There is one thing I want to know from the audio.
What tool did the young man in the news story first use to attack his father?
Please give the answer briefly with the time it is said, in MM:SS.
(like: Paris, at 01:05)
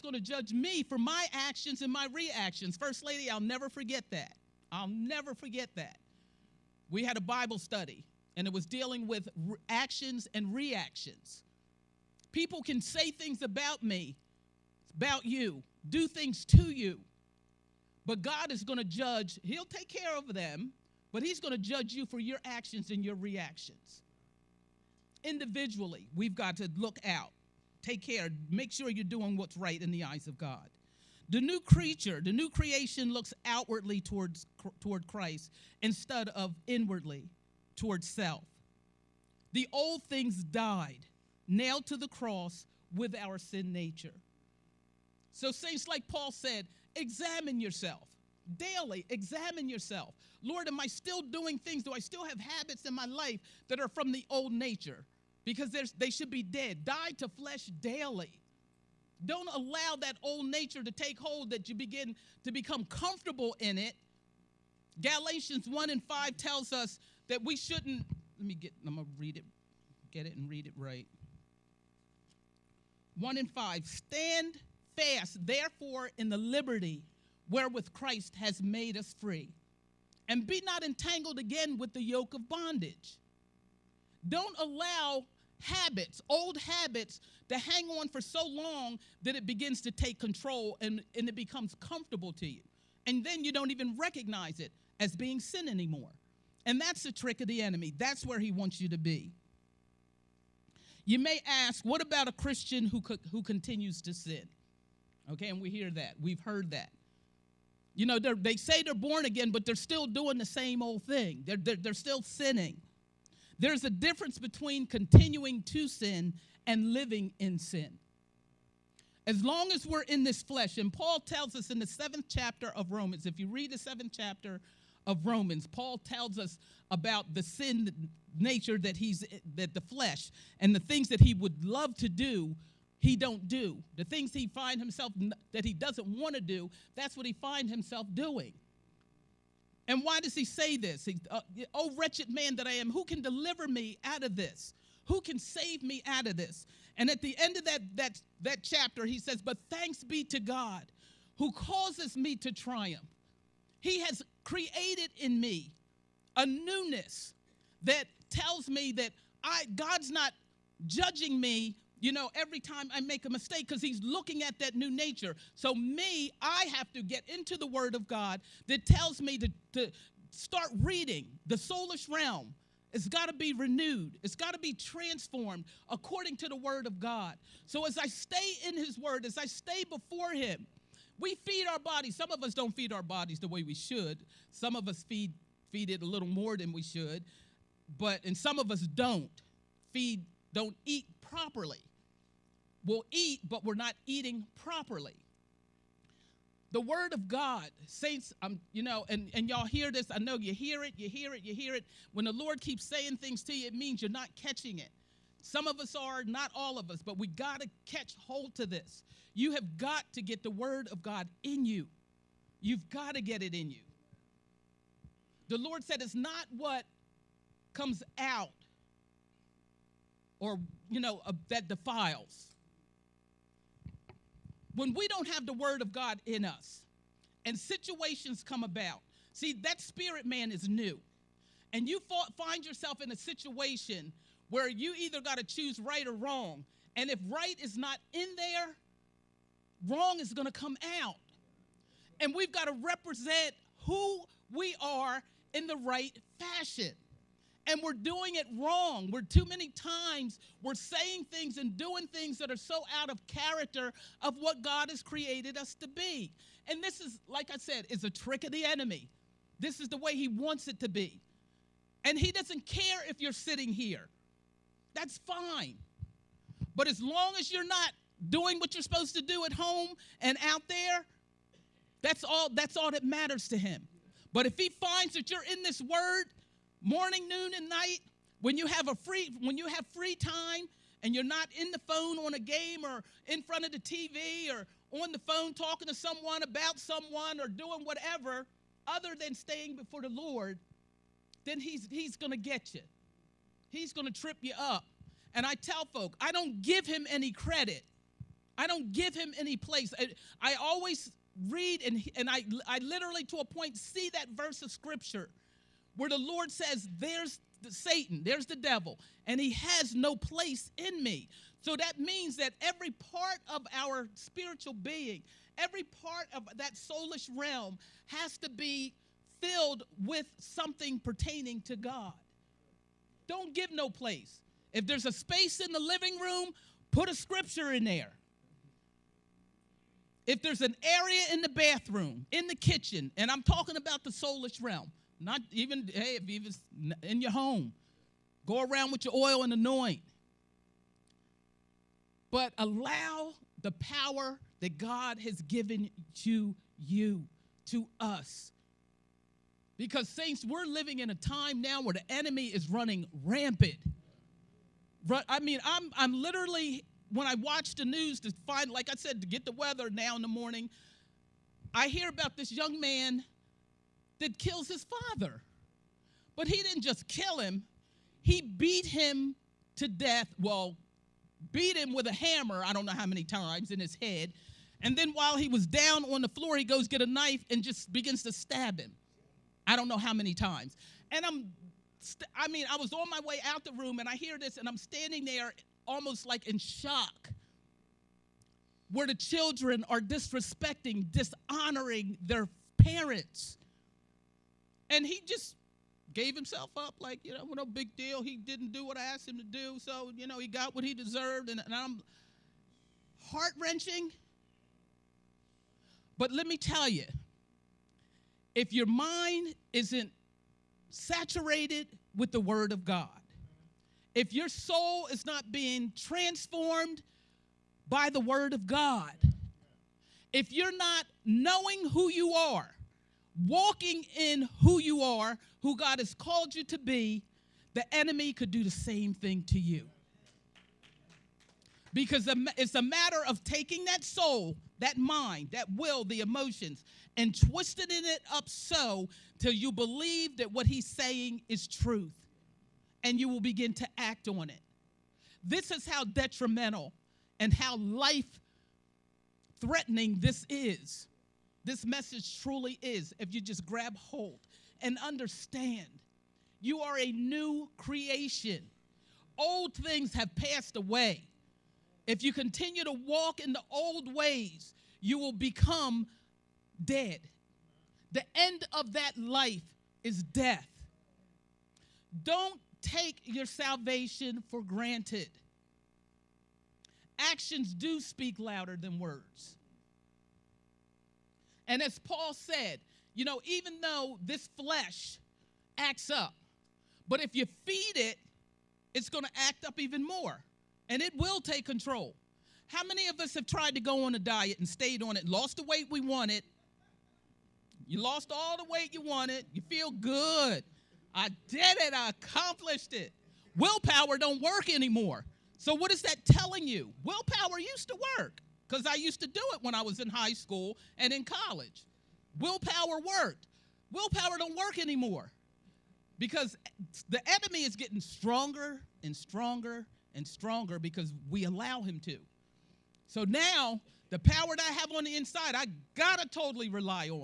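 A hammer, at 06:12.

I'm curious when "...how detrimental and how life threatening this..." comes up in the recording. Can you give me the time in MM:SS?
07:25.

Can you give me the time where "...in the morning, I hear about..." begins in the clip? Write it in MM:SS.
06:00.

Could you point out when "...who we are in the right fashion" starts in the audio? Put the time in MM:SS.
04:03.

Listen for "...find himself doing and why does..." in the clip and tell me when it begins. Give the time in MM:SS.
02:17.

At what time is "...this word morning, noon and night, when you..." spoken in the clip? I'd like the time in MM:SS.
04:35.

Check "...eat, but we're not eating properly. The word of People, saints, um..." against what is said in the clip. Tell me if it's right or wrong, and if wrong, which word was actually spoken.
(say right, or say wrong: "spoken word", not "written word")
wrong: "God", not "People".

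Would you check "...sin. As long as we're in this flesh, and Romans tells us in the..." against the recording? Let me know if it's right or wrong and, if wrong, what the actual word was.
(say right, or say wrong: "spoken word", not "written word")
wrong: "Paul", not "Romans".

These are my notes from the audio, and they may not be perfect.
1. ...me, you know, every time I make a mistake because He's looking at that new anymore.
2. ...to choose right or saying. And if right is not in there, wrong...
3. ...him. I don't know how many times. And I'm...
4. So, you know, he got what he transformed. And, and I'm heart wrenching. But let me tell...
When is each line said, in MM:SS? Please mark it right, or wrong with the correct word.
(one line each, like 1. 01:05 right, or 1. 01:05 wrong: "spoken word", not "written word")
1. 02:41 wrong: "nature", not "anymore"
2. 03:55 wrong: "wrong", not "saying"
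3. 06:18 right
4. 06:39 wrong: "deserved", not "transformed".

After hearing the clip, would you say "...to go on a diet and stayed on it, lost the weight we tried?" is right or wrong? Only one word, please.
wrong.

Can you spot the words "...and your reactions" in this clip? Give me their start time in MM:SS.
00:22.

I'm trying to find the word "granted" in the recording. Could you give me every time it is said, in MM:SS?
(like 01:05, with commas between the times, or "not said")
07:54.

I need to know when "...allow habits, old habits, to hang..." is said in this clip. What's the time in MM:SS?
01:24.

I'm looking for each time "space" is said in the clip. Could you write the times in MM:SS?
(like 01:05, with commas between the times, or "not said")
05:25.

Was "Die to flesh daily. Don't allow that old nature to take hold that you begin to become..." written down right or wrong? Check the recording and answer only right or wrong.
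right.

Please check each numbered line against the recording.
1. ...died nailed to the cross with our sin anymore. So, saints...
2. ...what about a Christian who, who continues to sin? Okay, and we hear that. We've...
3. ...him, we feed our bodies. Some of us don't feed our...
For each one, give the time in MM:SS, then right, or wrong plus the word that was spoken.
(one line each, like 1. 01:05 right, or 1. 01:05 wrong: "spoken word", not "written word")
1. 00:40 wrong: "nature", not "anymore"
2. 01:41 right
3. 03:00 right.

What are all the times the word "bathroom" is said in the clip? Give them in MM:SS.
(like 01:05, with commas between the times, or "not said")
05:31.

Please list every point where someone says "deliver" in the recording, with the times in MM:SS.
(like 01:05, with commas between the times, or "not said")
02:23.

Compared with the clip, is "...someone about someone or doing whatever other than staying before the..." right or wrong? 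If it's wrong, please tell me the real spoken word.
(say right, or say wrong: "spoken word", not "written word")
right.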